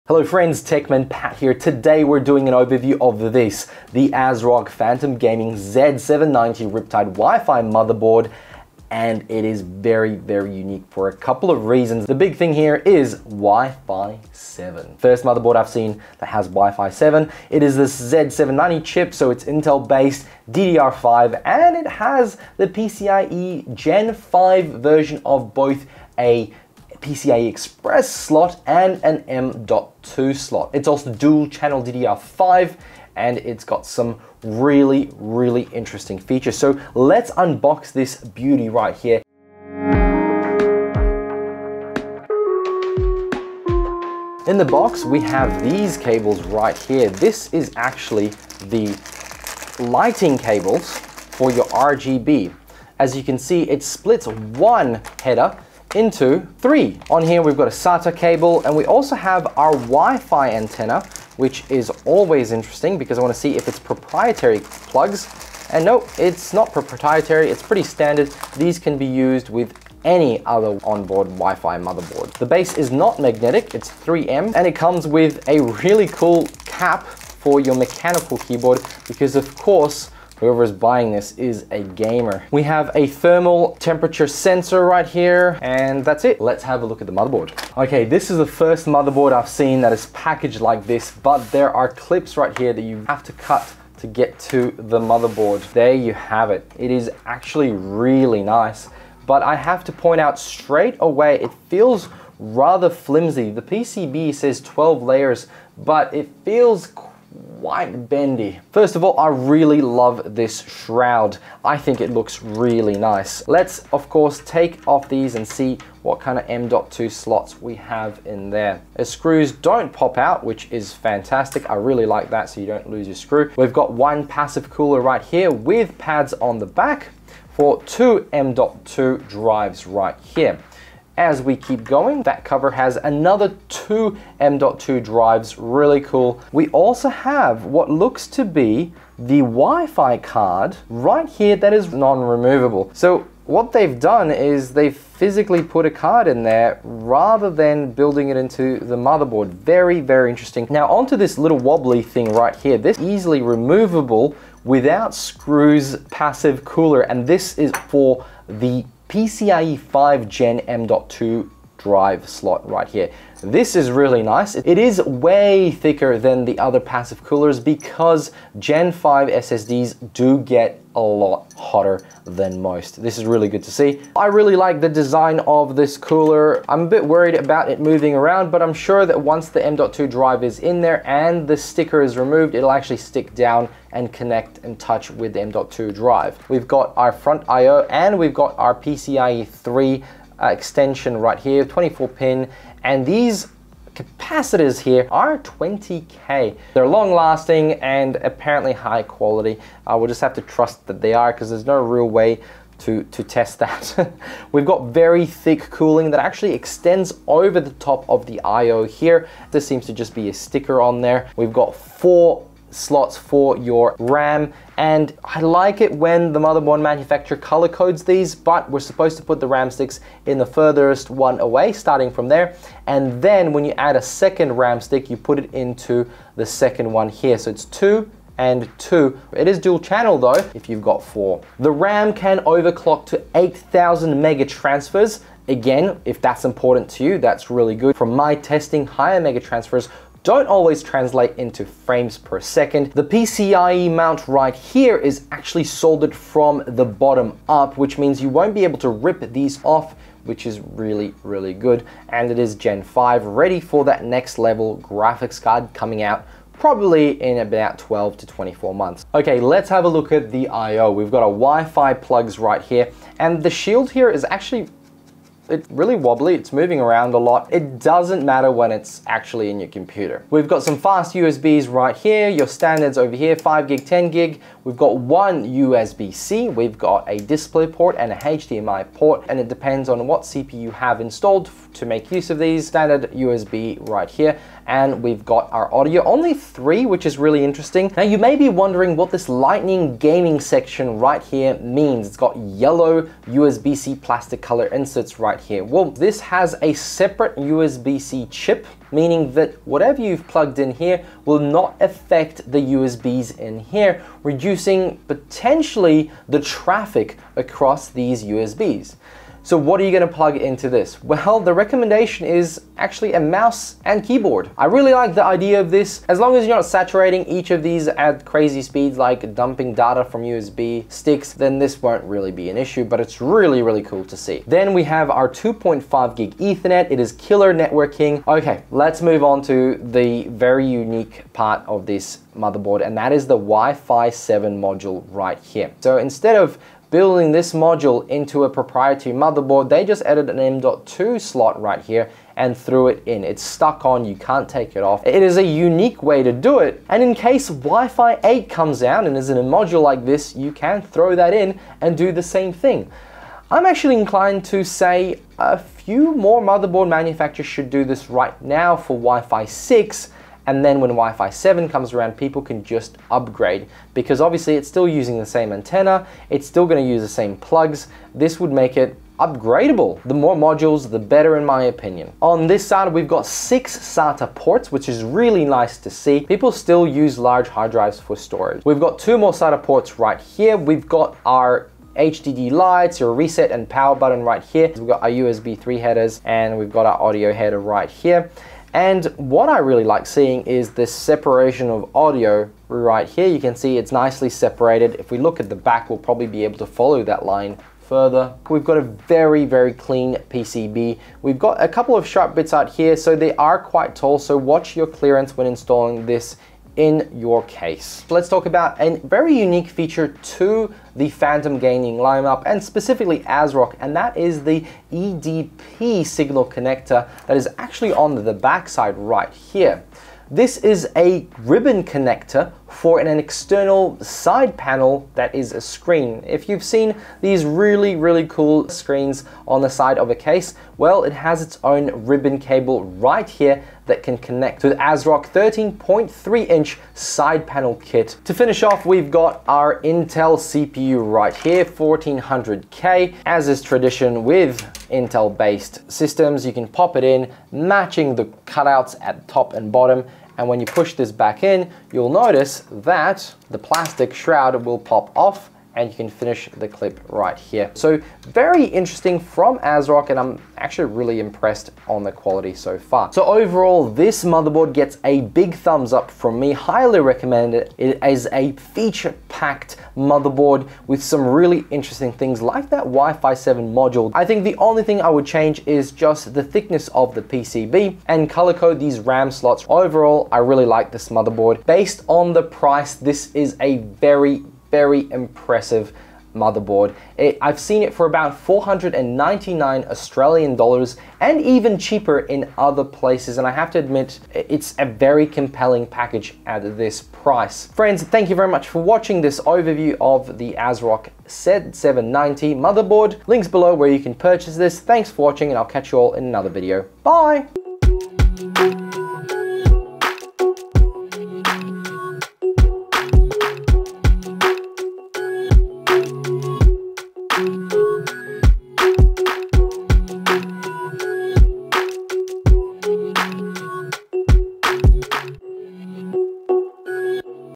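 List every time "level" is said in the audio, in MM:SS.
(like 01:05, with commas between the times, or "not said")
04:14.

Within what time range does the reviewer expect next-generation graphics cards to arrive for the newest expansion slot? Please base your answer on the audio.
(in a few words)
12 to 24 months.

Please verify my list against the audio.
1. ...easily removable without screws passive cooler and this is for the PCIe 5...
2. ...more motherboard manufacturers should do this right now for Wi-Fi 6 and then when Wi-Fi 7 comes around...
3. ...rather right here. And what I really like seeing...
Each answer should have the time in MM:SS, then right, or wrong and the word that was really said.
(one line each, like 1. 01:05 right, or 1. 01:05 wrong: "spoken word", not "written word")
1. 02:32 right
2. 05:56 right
3. 06:27 wrong: "header", not "rather".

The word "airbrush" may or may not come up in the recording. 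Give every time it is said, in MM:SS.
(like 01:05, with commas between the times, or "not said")
not said.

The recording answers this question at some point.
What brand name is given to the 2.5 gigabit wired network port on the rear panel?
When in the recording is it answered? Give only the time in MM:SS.
05:27.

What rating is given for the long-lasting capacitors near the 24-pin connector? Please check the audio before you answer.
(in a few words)
20k.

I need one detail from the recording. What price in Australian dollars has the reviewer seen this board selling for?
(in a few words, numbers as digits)
499.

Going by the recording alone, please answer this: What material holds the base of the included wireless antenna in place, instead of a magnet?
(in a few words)
3M.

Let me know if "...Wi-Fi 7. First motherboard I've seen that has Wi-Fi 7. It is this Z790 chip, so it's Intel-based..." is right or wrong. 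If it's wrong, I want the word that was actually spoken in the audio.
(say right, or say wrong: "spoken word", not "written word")
right.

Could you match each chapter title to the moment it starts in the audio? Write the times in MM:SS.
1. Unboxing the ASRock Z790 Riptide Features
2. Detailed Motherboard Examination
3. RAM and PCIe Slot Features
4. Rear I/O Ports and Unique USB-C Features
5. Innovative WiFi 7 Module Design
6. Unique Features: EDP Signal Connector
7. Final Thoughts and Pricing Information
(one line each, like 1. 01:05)
1. 01:13
2. 02:32
3. 03:50
4. 05:02
5. 06:14
6. 07:47
7. 08:18.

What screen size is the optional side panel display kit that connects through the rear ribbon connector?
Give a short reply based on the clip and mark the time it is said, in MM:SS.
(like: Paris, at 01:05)
13.3 inch, at 07:15.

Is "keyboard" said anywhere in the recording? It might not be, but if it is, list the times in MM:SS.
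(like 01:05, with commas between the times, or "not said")
01:18, 05:14.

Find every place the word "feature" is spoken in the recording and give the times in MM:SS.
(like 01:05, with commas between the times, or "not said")
00:36, 06:49, 07:48.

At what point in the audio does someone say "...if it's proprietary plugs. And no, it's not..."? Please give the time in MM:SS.
01:03.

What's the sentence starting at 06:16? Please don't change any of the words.
People still use large hard drives for storage.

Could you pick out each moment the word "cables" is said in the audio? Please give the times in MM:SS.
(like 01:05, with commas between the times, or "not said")
00:45, 00:50, 00:58, 07:12.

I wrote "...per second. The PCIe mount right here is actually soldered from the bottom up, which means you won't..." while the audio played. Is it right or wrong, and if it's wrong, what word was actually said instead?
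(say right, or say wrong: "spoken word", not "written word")
right.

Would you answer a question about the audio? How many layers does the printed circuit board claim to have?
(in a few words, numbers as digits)
12.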